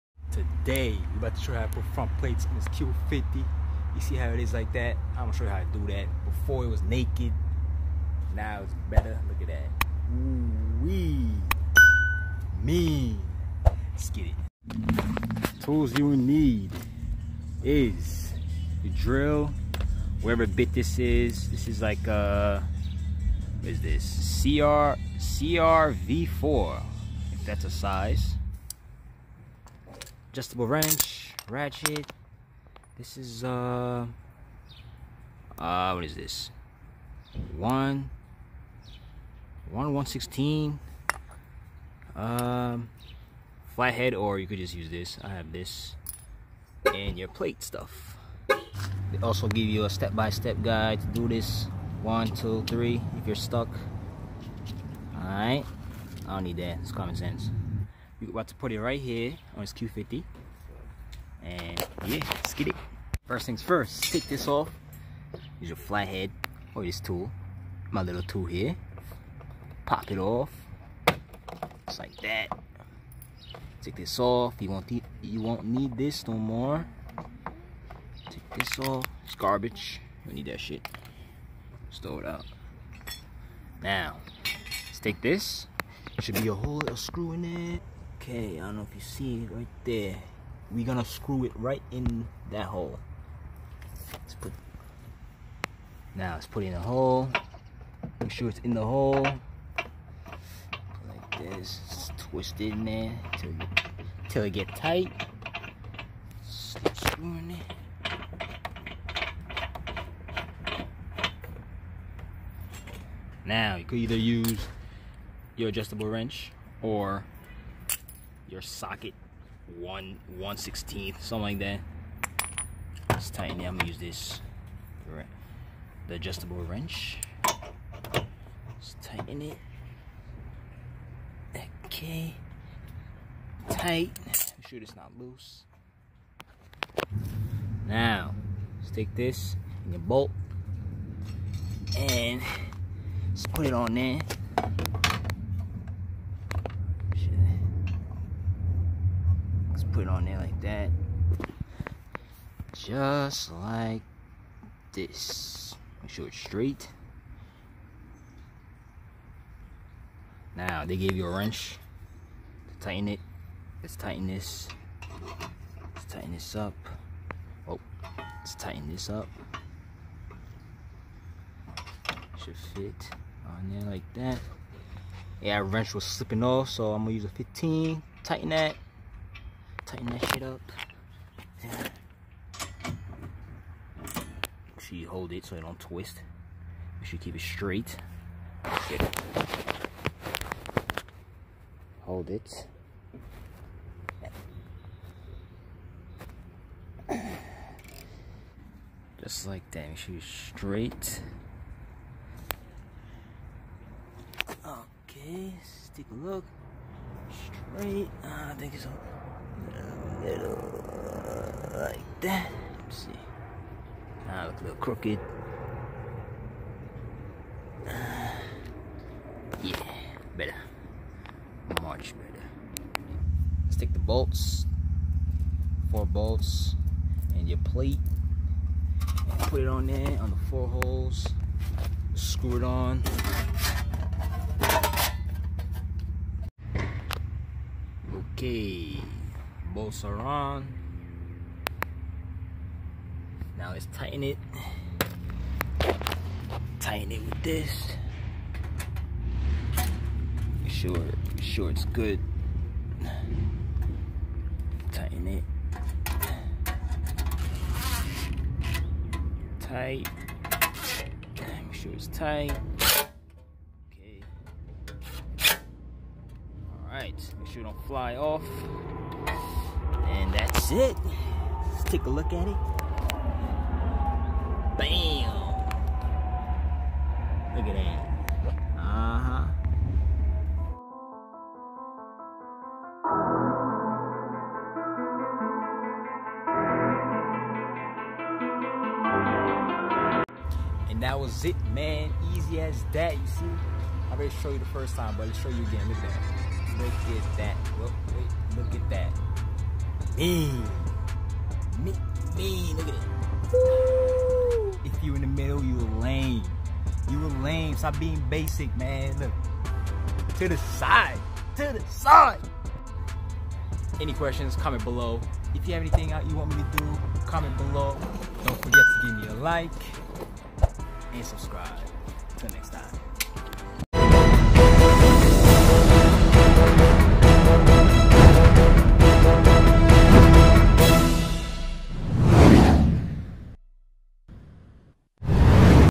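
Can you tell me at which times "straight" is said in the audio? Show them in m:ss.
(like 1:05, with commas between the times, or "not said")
2:36, 3:07, 3:20, 3:27.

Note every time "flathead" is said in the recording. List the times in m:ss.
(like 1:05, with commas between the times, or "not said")
0:43, 1:05.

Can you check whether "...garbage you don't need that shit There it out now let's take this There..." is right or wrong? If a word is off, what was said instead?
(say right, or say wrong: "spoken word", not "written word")
wrong: "Stow", not "There".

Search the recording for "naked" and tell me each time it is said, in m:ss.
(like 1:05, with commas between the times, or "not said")
0:06.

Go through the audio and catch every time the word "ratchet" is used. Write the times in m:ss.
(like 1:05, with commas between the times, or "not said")
0:31.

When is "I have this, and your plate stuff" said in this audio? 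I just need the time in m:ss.
0:45.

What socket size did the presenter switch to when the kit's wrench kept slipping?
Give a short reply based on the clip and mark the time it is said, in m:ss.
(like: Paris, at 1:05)
15, at 2:57.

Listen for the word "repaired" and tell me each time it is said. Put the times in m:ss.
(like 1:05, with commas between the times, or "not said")
not said.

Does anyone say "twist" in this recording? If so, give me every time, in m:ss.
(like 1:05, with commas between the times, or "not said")
1:42, 3:05.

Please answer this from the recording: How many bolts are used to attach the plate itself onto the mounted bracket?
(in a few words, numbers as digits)
4.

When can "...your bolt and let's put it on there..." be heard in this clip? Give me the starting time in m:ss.
2:19.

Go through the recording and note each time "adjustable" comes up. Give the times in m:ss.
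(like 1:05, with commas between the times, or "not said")
0:30, 1:55, 2:06.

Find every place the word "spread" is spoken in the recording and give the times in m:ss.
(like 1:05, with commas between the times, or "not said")
not said.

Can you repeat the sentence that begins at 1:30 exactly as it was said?
We're gonna screw it right in that hole.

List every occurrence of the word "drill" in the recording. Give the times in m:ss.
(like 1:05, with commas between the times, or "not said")
0:18.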